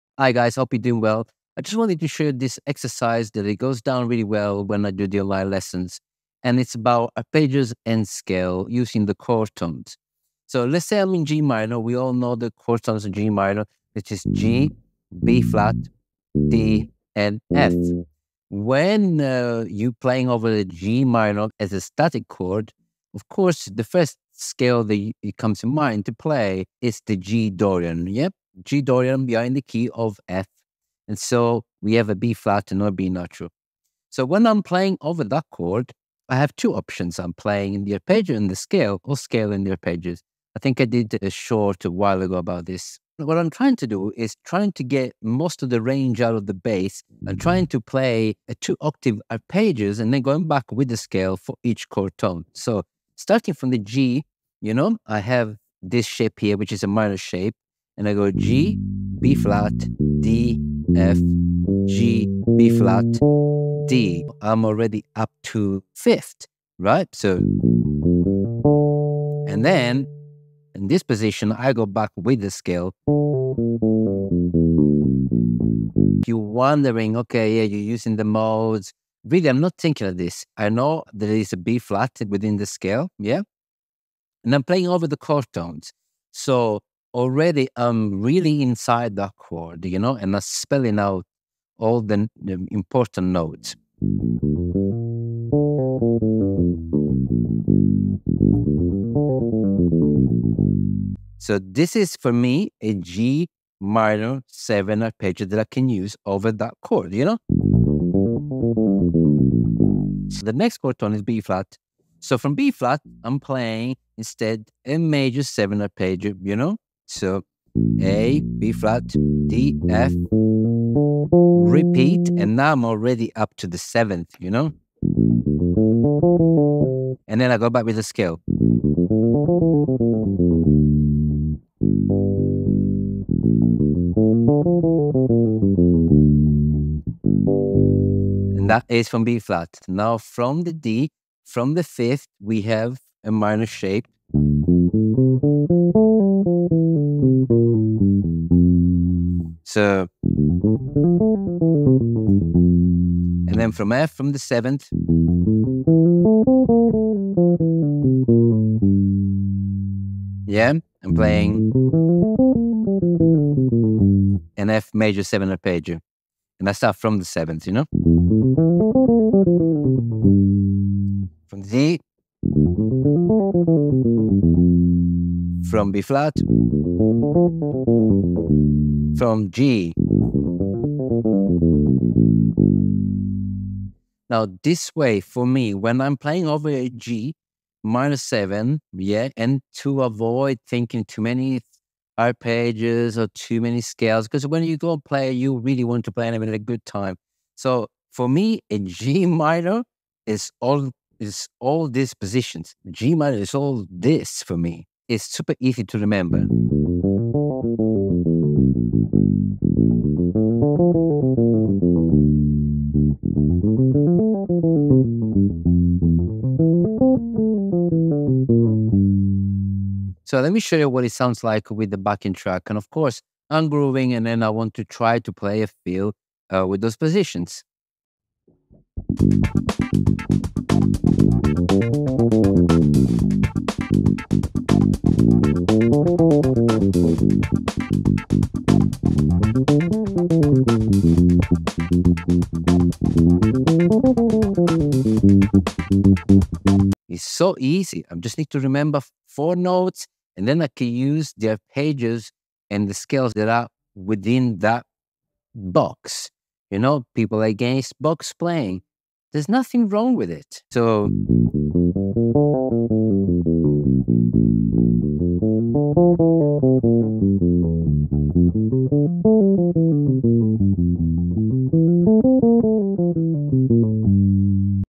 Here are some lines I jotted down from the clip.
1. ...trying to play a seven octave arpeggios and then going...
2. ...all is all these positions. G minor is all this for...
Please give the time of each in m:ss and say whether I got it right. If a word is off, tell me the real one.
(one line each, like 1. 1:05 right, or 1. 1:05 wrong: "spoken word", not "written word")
1. 0:47 wrong: "two", not "seven"
2. 3:20 right.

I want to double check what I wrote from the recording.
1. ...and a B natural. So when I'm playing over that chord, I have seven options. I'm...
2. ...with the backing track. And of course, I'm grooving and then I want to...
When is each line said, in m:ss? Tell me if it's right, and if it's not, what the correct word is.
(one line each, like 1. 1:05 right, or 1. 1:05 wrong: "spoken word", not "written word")
1. 0:32 wrong: "two", not "seven"
2. 3:41 right.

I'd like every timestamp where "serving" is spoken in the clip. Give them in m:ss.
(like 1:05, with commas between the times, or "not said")
not said.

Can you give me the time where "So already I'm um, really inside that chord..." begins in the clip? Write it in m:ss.
1:26.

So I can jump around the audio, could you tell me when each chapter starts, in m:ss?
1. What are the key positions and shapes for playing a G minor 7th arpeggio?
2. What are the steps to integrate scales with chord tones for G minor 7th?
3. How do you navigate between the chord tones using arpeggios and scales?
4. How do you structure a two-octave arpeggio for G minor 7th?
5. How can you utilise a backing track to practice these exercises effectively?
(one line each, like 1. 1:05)
1. 1:10
2. 0:35
3. 0:52
4. 0:10
5. 1:40.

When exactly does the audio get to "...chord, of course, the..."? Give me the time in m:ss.
0:22.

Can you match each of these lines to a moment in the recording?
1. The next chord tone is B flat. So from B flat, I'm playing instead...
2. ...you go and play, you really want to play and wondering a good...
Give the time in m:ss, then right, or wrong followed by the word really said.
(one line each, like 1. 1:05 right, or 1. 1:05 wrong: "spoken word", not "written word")
1. 1:50 right
2. 3:14 wrong: "having", not "wondering".